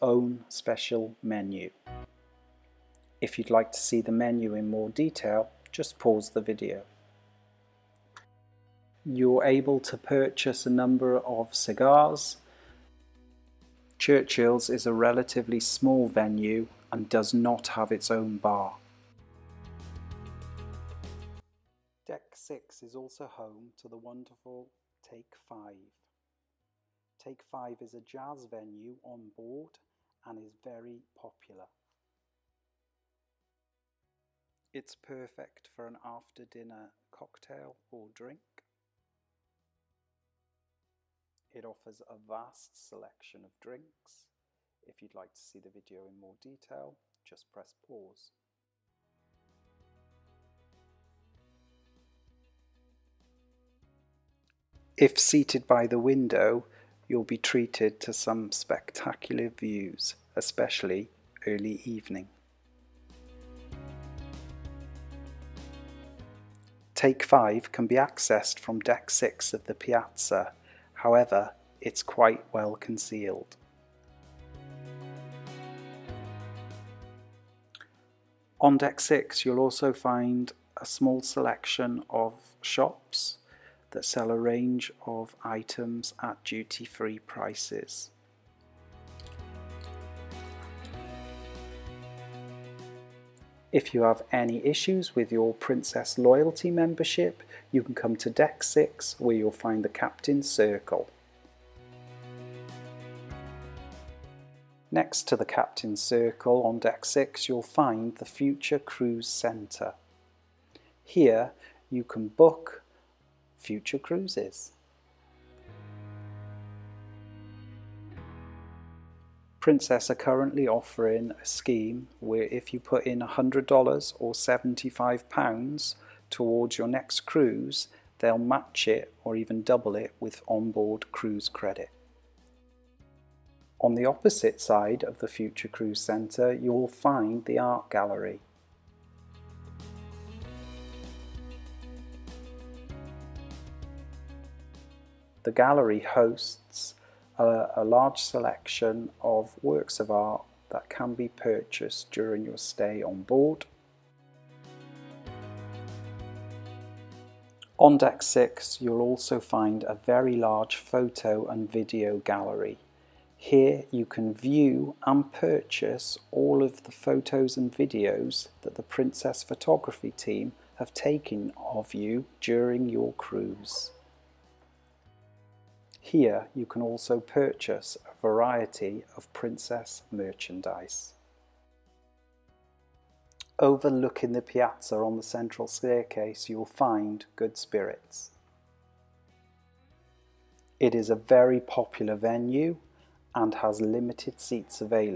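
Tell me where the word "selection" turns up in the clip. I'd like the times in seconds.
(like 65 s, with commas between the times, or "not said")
42 s, 81 s, 148 s.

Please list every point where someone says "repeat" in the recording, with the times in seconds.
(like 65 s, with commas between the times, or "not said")
not said.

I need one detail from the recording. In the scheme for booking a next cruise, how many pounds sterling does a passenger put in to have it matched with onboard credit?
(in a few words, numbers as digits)
£75.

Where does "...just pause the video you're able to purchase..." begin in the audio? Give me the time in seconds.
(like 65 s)
5 s.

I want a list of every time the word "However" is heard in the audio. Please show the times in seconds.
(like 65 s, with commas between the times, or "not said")
71 s.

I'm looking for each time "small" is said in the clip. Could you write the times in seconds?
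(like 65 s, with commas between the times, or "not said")
15 s, 80 s.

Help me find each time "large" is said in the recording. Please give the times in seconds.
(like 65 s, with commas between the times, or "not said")
147 s, 160 s.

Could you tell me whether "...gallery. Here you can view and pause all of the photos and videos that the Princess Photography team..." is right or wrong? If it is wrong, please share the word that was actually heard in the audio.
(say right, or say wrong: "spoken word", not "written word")
wrong: "purchase", not "pause".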